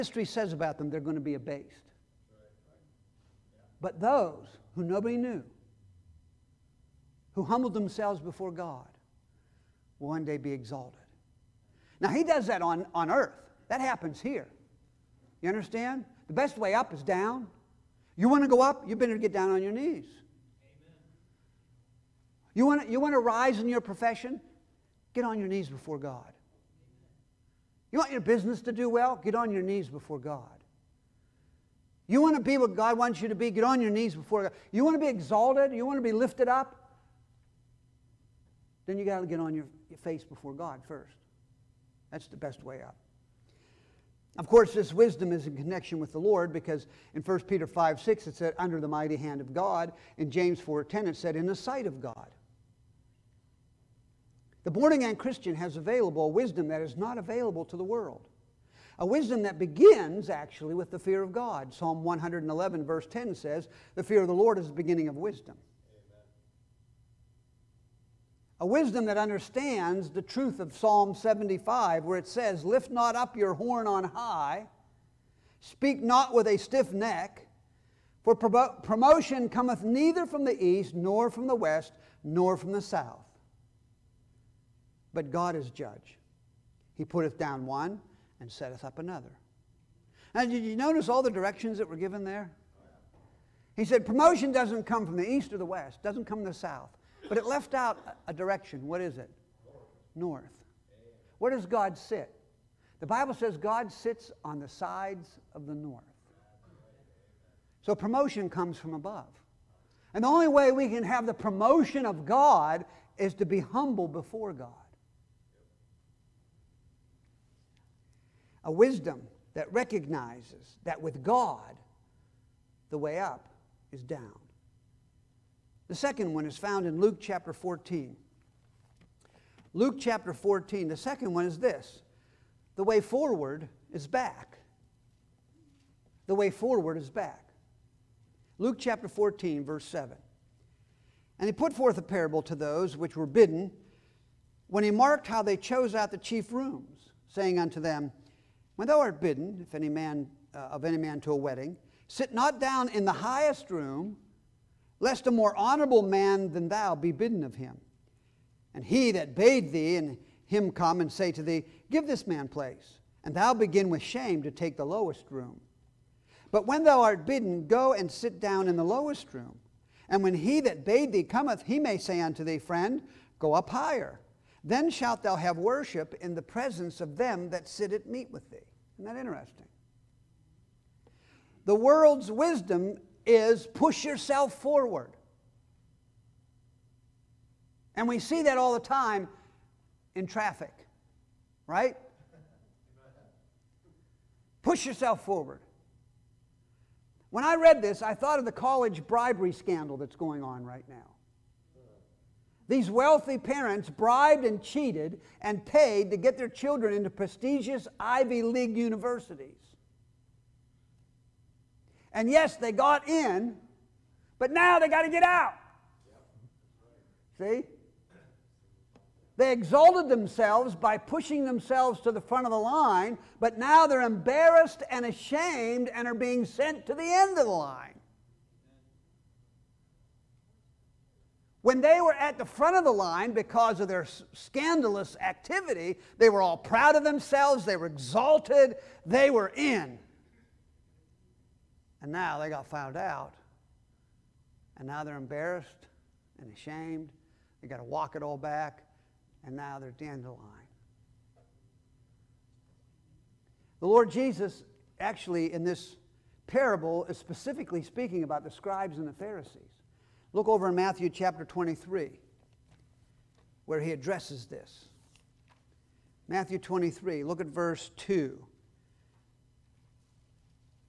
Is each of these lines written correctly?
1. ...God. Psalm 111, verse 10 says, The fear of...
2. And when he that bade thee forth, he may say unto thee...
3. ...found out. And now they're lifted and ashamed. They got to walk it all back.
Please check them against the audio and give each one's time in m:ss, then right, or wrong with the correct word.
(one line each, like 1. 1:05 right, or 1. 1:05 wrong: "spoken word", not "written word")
1. 1:01 right
2. 2:50 wrong: "cometh", not "forth"
3. 4:02 wrong: "embarrassed", not "lifted".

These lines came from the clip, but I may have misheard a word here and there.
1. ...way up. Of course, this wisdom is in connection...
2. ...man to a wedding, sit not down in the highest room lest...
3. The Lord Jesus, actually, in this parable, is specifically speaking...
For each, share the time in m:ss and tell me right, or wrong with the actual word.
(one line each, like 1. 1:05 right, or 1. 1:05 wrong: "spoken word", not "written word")
1. 0:42 right
2. 2:30 right
3. 4:13 right.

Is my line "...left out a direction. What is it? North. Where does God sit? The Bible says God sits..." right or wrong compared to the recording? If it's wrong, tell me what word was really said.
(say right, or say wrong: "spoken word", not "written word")
right.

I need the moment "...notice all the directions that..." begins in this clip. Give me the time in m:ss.
1:30.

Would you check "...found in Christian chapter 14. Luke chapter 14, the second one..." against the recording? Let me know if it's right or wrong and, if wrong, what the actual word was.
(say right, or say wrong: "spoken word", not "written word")
wrong: "Luke", not "Christian".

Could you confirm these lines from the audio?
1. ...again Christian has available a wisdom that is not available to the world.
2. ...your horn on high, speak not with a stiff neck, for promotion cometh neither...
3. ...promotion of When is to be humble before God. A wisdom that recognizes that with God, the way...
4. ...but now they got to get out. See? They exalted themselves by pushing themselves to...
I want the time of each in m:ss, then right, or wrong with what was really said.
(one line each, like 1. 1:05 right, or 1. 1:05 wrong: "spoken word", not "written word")
1. 0:54 right
2. 1:13 right
3. 1:51 wrong: "God", not "When"
4. 3:34 right.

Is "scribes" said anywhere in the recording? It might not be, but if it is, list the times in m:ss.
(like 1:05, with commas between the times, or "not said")
4:18.